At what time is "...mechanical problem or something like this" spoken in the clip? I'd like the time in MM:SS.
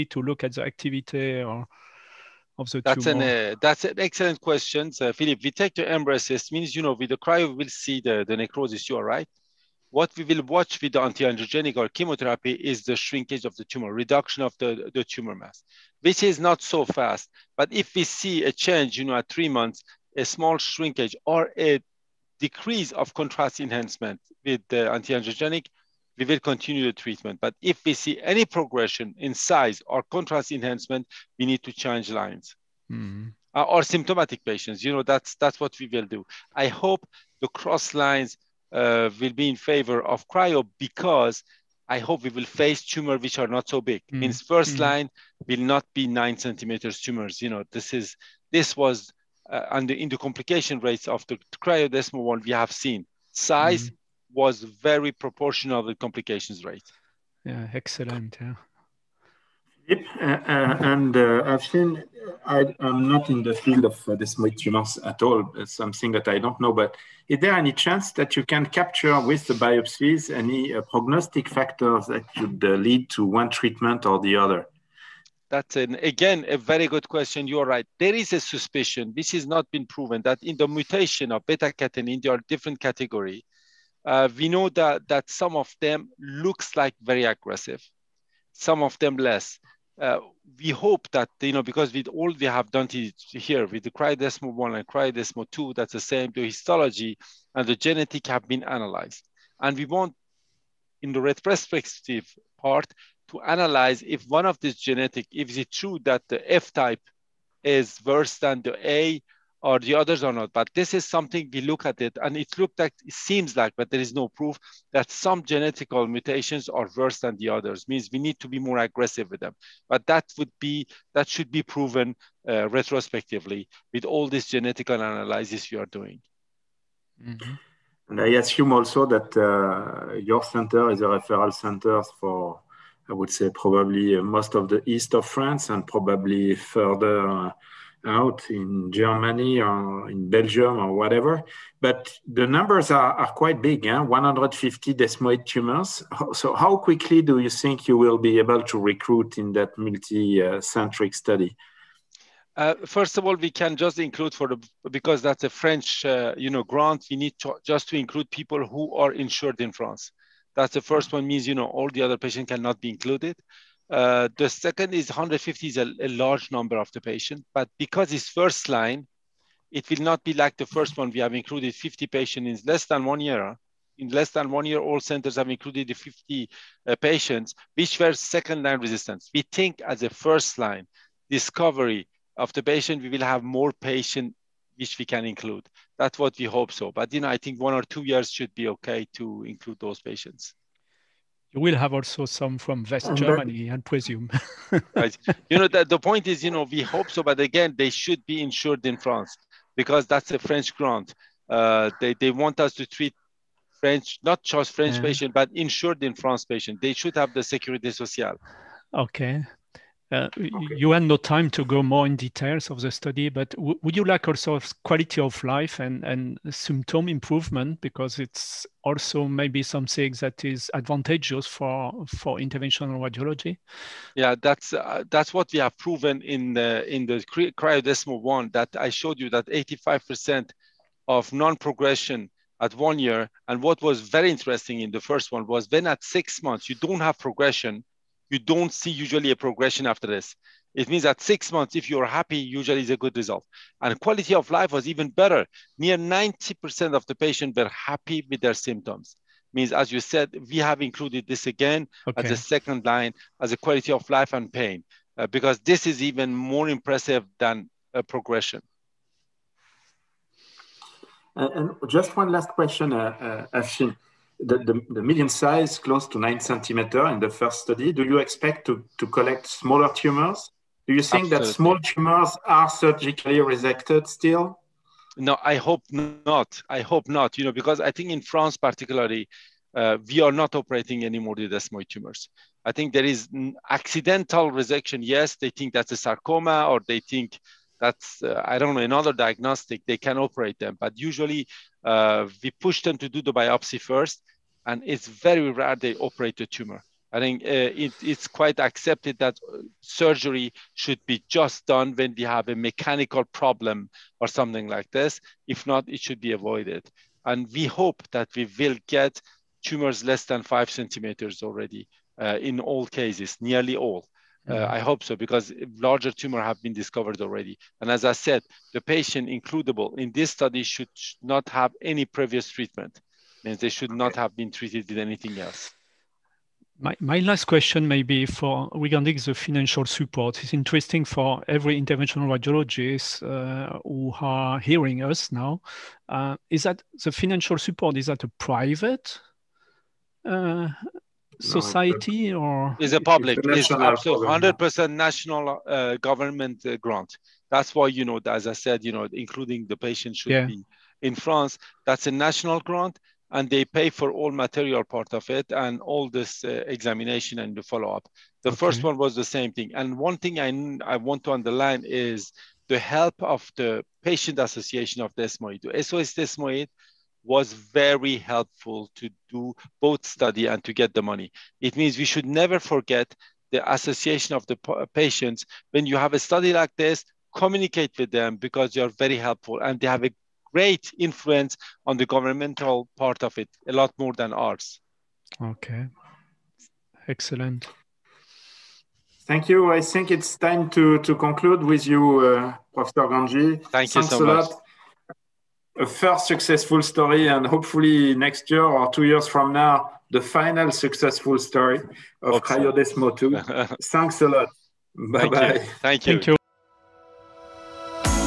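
05:02.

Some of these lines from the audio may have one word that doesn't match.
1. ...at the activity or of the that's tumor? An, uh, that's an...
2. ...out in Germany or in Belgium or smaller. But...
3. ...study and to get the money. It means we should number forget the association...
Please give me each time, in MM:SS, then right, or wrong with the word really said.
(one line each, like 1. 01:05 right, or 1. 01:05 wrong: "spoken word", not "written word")
1. 00:00 right
2. 02:18 wrong: "whatever", not "smaller"
3. 06:10 wrong: "never", not "number".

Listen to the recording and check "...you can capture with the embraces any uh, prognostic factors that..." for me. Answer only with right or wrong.
wrong.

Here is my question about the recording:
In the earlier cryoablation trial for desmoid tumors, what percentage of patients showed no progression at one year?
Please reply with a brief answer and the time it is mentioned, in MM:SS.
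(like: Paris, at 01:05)
85%, at 03:49.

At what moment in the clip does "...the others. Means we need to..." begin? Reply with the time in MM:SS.
01:57.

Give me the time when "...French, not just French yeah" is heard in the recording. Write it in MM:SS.
03:23.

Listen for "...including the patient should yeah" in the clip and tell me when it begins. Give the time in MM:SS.
05:49.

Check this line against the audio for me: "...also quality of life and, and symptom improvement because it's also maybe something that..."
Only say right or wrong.
right.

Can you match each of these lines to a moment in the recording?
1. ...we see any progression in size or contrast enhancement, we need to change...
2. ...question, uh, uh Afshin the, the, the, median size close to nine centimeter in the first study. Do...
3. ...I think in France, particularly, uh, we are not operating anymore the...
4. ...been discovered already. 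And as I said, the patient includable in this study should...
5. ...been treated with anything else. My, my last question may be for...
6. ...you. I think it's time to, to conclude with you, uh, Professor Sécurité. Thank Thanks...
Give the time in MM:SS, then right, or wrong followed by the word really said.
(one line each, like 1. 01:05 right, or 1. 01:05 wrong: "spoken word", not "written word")
1. 00:27 right
2. 04:22 right
3. 04:37 right
4. 05:16 right
5. 05:24 right
6. 06:29 wrong: "Gangi", not "Sécurité".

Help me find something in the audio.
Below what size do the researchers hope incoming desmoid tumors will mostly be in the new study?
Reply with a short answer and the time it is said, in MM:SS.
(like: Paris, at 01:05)
5 centimeters, at 05:10.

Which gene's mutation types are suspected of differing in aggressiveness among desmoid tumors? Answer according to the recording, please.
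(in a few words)
Beta catenin.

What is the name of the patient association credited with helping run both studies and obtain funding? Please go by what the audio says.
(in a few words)
SOS Desmoid.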